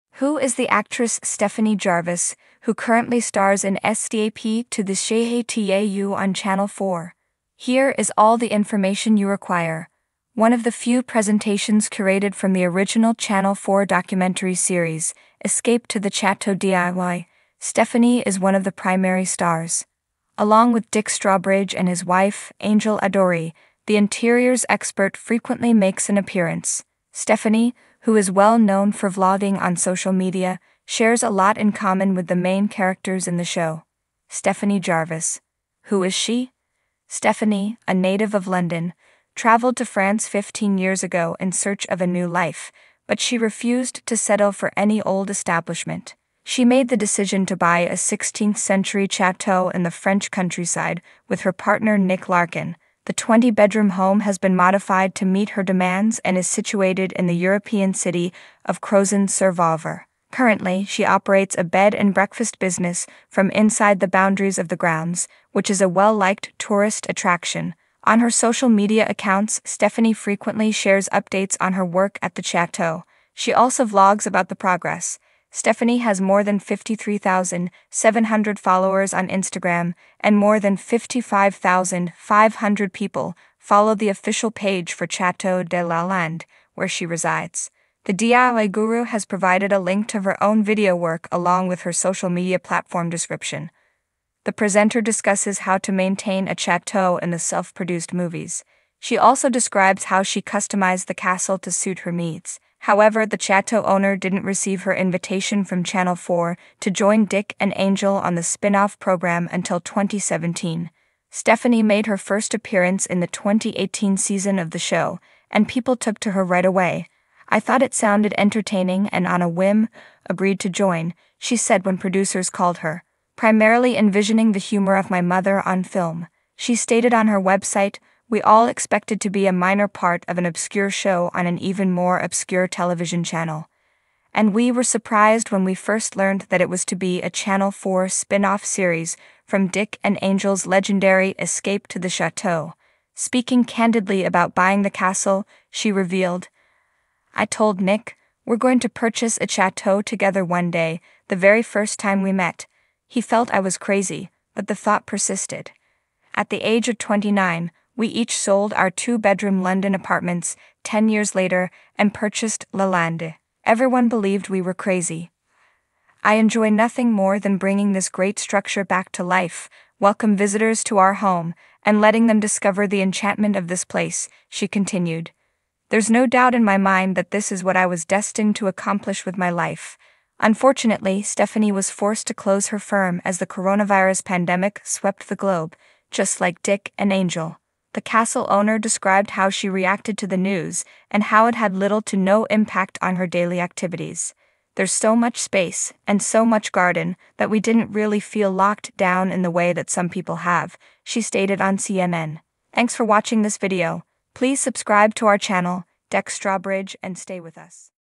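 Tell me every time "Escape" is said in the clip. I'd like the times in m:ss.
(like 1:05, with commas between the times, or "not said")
0:03, 0:15, 2:21.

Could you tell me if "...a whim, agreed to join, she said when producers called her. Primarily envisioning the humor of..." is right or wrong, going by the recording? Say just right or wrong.
right.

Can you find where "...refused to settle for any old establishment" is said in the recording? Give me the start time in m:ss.
0:43.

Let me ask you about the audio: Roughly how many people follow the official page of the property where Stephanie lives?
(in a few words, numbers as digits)
55,500.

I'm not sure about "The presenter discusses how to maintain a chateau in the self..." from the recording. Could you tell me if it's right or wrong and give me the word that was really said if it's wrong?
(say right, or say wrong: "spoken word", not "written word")
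right.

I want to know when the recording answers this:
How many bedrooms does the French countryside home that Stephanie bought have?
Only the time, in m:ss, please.
0:53.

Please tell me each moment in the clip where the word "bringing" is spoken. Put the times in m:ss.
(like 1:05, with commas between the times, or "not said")
2:47.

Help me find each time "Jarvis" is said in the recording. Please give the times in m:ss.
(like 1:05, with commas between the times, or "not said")
0:01, 0:34.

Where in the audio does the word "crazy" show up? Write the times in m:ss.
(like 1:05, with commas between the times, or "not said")
2:33, 2:44.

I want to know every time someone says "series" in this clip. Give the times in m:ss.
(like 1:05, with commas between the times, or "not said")
0:14, 2:18.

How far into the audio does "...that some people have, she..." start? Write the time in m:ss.
3:19.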